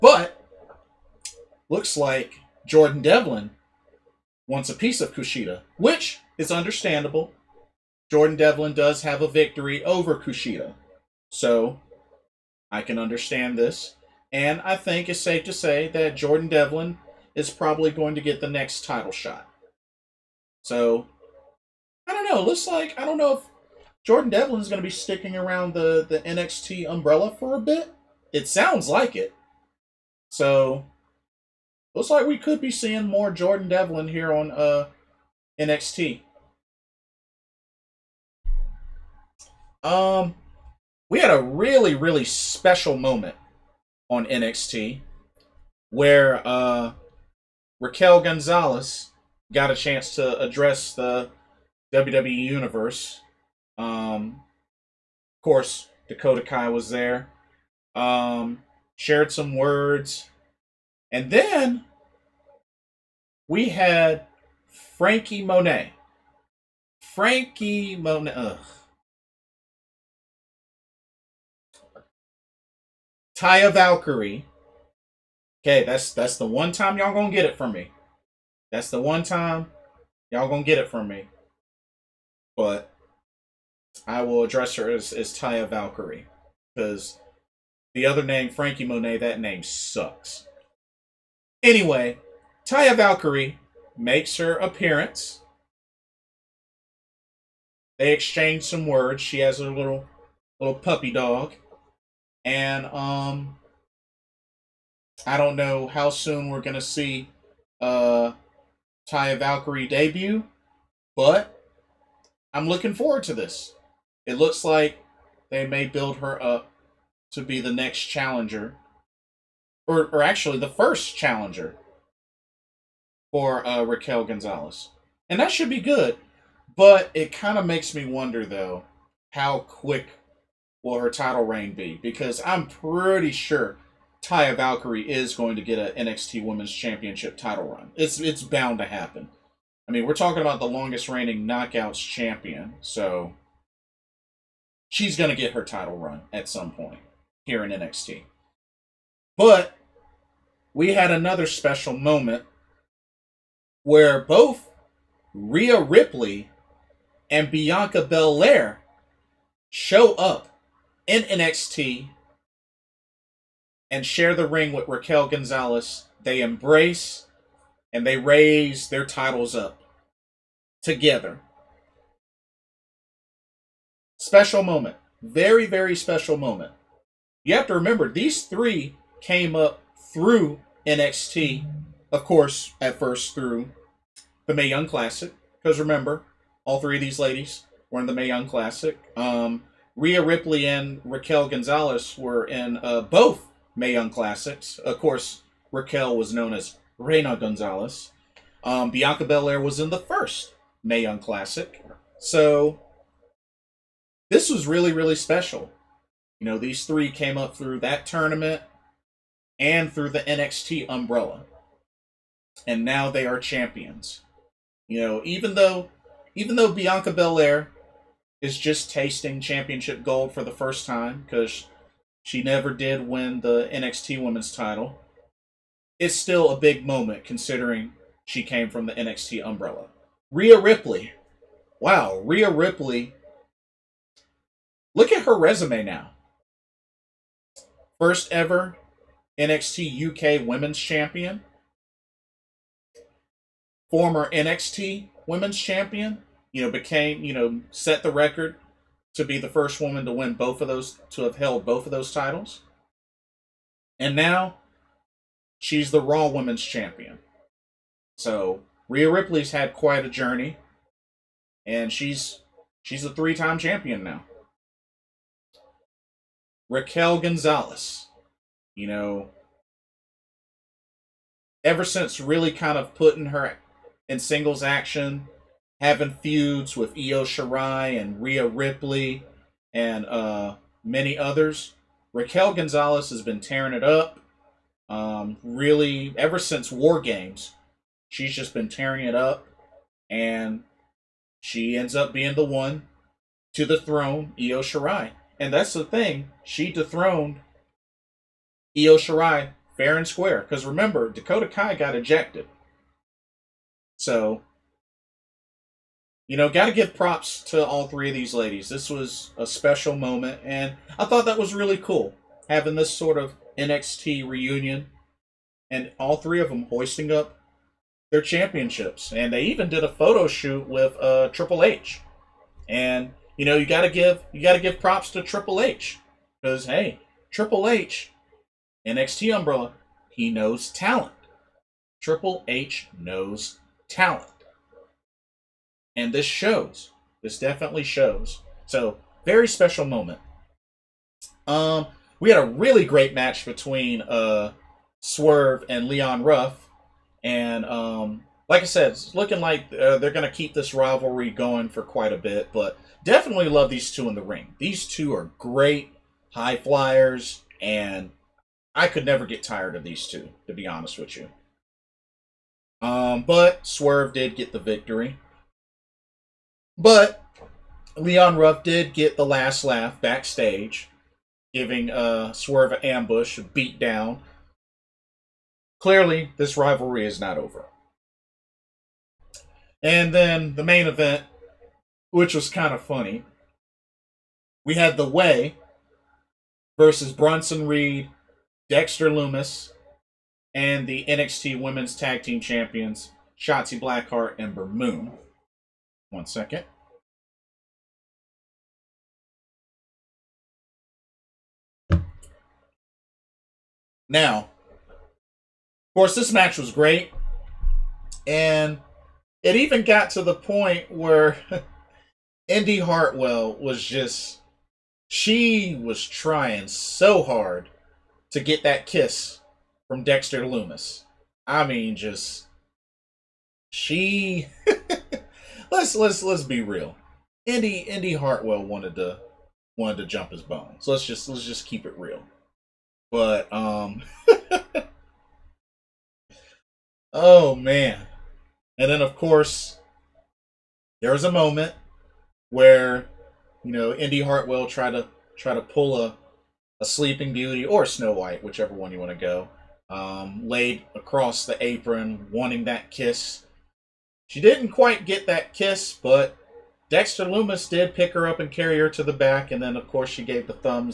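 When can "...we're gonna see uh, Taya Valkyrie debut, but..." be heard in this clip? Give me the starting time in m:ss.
1:46.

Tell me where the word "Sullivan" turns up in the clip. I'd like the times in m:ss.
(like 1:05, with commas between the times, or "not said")
not said.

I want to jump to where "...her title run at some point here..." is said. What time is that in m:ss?
2:25.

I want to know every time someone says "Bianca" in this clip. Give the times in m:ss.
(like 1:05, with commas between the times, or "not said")
2:37, 3:18, 3:36.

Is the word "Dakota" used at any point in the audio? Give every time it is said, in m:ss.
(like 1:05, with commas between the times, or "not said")
0:56, 5:01.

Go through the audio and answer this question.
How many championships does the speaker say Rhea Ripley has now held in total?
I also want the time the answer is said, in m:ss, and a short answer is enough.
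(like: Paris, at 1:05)
3, at 4:23.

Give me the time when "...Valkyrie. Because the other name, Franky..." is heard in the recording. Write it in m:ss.
1:25.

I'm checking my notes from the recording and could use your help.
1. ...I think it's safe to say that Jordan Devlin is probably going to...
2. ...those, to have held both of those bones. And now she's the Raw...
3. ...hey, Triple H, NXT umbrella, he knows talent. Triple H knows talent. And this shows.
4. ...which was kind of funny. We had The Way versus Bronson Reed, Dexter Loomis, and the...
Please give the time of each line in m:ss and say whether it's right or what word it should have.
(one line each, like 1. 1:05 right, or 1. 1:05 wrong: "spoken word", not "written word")
1. 0:14 right
2. 4:10 wrong: "titles", not "bones"
3. 5:26 right
4. 6:22 right.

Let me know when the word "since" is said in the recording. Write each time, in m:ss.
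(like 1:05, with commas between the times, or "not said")
4:31, 4:46.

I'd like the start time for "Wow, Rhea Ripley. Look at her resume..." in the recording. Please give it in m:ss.
3:51.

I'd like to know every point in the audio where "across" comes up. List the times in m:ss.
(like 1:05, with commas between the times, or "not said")
7:30.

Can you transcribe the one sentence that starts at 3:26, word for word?
You know, these three came up through that tournament and through the NXT umbrella.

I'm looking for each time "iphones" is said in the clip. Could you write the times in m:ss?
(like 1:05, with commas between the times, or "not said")
not said.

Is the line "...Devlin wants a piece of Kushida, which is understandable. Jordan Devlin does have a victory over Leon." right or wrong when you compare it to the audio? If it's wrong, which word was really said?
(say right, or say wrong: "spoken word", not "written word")
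wrong: "Kushida", not "Leon".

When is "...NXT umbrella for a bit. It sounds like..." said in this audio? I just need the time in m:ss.
0:26.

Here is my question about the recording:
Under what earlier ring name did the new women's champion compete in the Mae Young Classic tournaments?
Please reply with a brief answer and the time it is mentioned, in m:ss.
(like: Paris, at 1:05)
Reina Gonzalez, at 3:16.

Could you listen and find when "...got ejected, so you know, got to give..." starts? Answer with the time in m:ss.
5:01.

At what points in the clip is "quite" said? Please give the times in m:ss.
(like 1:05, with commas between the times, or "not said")
4:19, 5:51, 7:34.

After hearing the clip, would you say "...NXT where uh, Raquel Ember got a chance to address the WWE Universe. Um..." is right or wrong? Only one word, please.
wrong.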